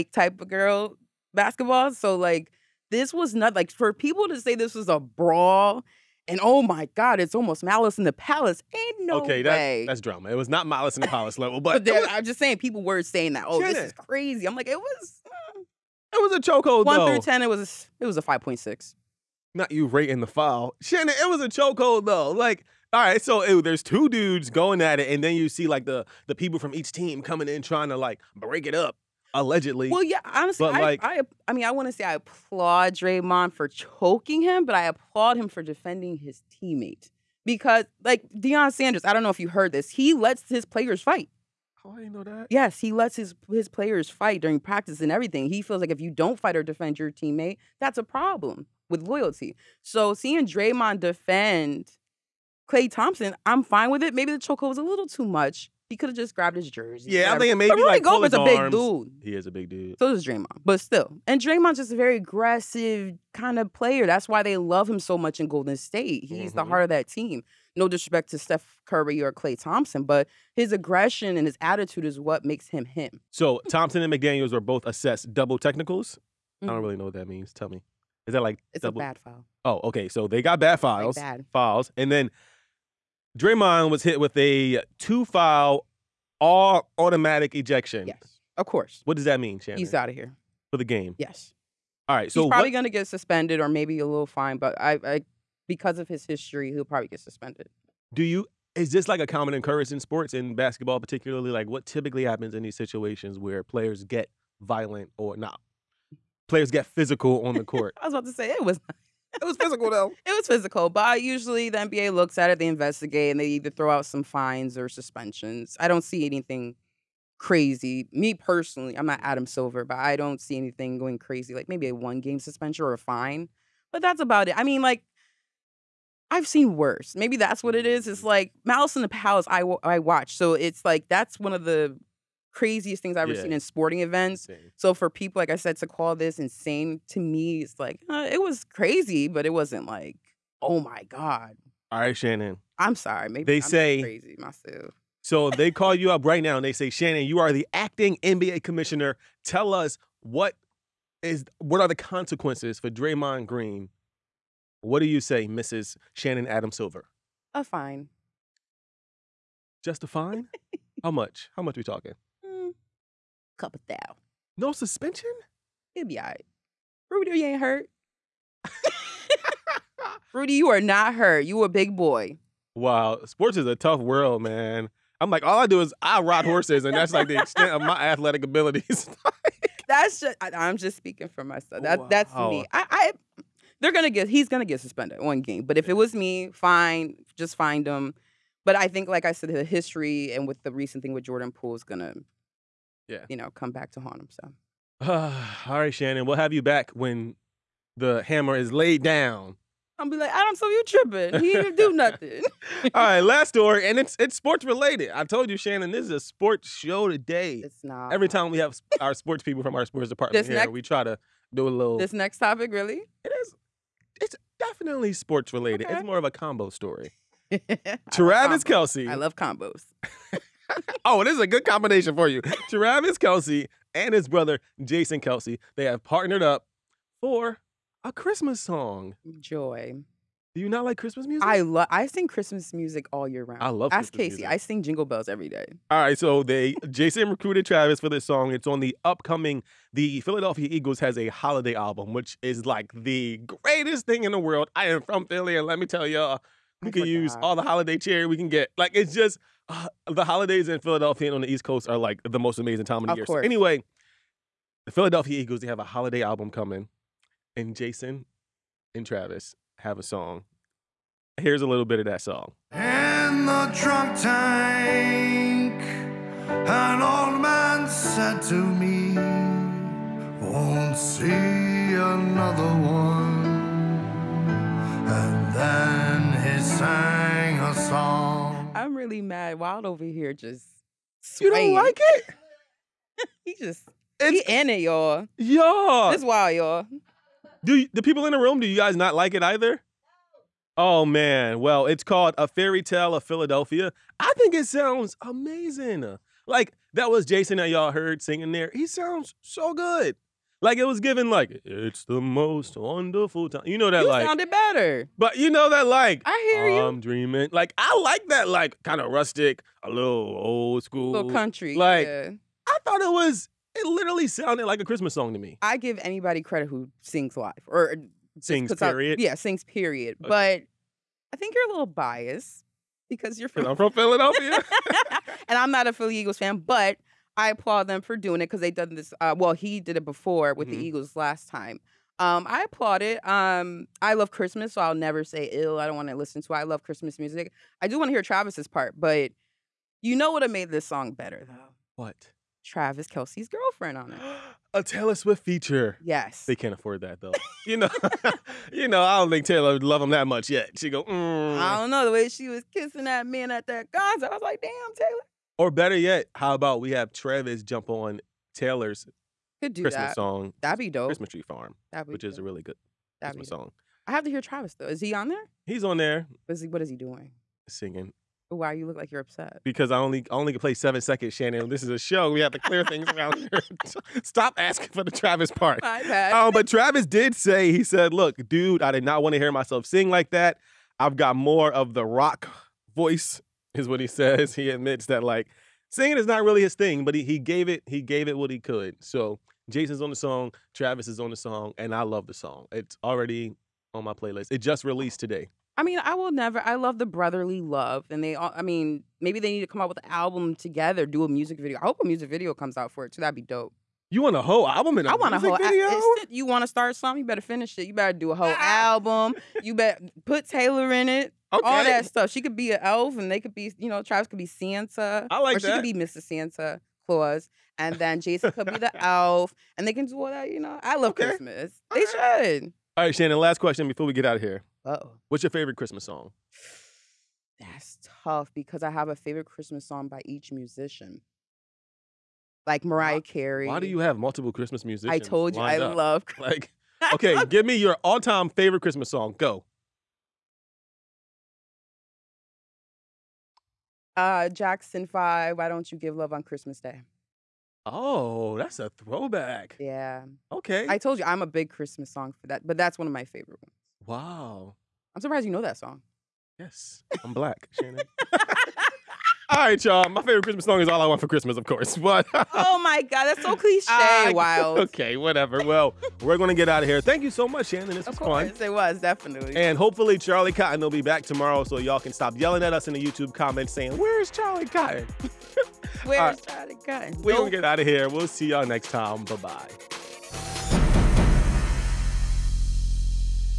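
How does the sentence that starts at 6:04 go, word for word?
I have to hear Travis though.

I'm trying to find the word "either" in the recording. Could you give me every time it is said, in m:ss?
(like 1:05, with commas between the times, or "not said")
1:53, 4:49.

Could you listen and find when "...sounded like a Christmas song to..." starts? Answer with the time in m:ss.
5:14.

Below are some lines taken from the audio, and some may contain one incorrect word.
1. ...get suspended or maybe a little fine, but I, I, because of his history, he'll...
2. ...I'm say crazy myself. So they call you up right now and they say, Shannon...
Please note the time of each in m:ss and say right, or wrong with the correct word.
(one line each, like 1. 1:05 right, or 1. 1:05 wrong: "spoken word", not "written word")
1. 1:32 right
2. 2:23 right.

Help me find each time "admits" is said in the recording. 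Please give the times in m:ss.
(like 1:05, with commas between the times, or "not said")
6:24.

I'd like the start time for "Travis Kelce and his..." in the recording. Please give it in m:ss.
3:42.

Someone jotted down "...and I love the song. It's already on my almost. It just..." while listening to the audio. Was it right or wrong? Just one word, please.
wrong.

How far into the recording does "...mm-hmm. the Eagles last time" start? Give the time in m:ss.
5:30.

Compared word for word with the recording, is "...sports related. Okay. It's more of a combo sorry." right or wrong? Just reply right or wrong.
wrong.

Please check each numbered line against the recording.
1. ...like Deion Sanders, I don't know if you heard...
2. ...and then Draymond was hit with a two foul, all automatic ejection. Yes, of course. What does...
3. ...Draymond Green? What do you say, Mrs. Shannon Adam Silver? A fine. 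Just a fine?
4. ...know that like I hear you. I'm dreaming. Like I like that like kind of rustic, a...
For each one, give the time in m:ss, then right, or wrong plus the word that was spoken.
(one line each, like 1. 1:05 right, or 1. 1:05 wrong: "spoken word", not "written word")
1. 0:38 right
2. 1:21 right
3. 2:32 right
4. 5:05 right.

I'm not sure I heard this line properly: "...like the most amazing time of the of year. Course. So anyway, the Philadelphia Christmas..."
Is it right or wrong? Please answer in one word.
wrong.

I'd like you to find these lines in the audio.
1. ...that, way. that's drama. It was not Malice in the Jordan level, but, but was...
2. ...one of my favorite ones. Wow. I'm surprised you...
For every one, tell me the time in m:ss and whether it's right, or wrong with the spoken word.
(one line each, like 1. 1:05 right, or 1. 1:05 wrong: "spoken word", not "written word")
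1. 0:09 wrong: "Palace", not "Jordan"
2. 7:32 right.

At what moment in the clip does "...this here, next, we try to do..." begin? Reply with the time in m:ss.
3:30.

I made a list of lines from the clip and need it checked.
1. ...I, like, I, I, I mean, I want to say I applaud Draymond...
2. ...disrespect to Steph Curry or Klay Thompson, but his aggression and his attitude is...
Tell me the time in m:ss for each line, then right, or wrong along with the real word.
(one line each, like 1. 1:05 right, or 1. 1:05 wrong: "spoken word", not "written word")
1. 0:30 right
2. 1:07 right.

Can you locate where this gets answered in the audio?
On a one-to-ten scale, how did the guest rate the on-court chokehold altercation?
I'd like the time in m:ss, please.
0:18.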